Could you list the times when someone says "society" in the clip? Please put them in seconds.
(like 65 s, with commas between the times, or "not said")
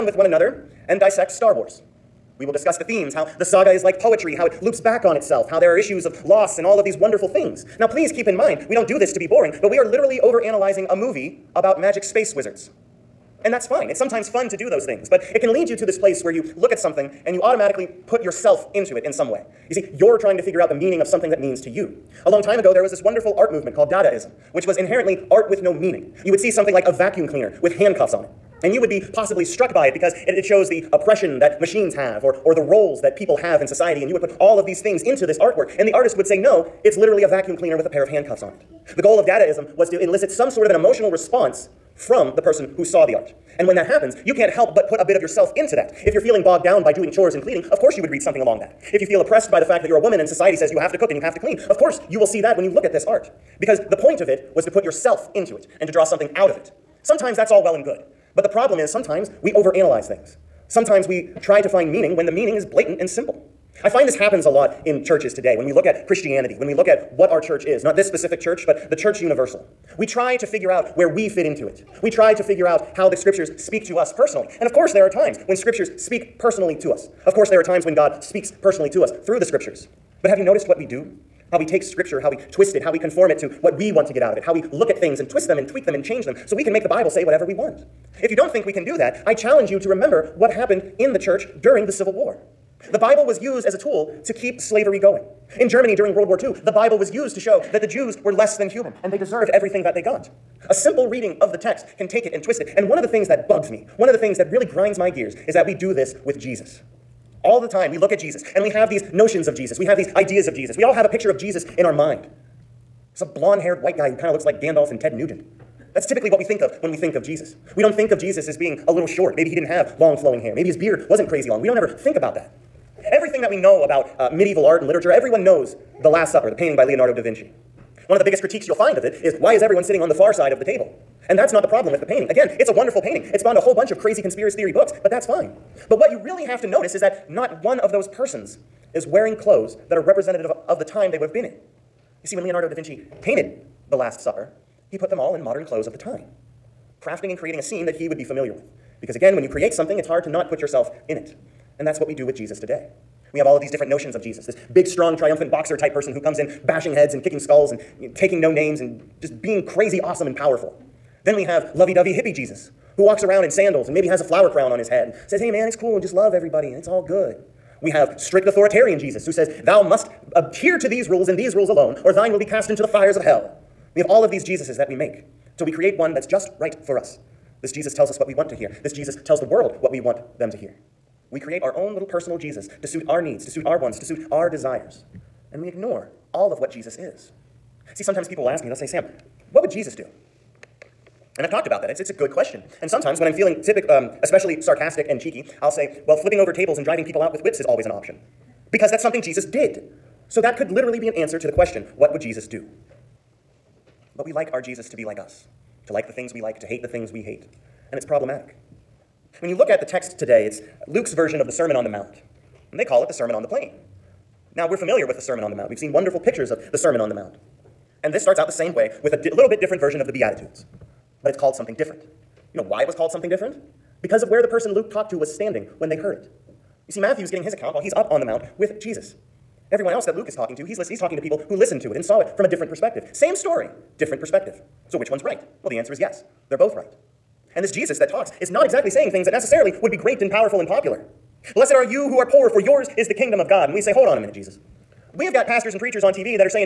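33 s, 50 s.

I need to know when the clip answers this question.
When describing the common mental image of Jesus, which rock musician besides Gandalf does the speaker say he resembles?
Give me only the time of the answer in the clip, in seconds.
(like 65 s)
115 s.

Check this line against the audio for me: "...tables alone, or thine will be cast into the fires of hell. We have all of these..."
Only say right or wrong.
wrong.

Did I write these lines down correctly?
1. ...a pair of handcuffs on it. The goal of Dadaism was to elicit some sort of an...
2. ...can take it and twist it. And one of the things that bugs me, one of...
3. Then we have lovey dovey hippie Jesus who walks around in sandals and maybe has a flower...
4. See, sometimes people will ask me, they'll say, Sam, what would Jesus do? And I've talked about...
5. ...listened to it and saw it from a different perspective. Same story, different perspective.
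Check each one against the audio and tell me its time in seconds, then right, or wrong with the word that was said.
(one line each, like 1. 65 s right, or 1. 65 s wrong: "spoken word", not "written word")
1. 37 s right
2. 101 s right
3. 161 s right
4. 187 s right
5. 231 s right.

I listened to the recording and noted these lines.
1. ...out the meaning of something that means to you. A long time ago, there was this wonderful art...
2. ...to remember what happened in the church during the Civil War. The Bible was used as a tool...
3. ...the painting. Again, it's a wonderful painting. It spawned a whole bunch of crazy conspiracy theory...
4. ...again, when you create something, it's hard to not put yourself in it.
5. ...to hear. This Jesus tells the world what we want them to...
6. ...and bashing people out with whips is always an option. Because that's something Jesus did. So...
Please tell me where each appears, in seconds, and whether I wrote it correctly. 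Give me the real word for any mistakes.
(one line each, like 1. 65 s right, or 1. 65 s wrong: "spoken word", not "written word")
1. 20 s right
2. 89 s right
3. 132 s right
4. 149 s right
5. 178 s right
6. 196 s wrong: "driving", not "bashing".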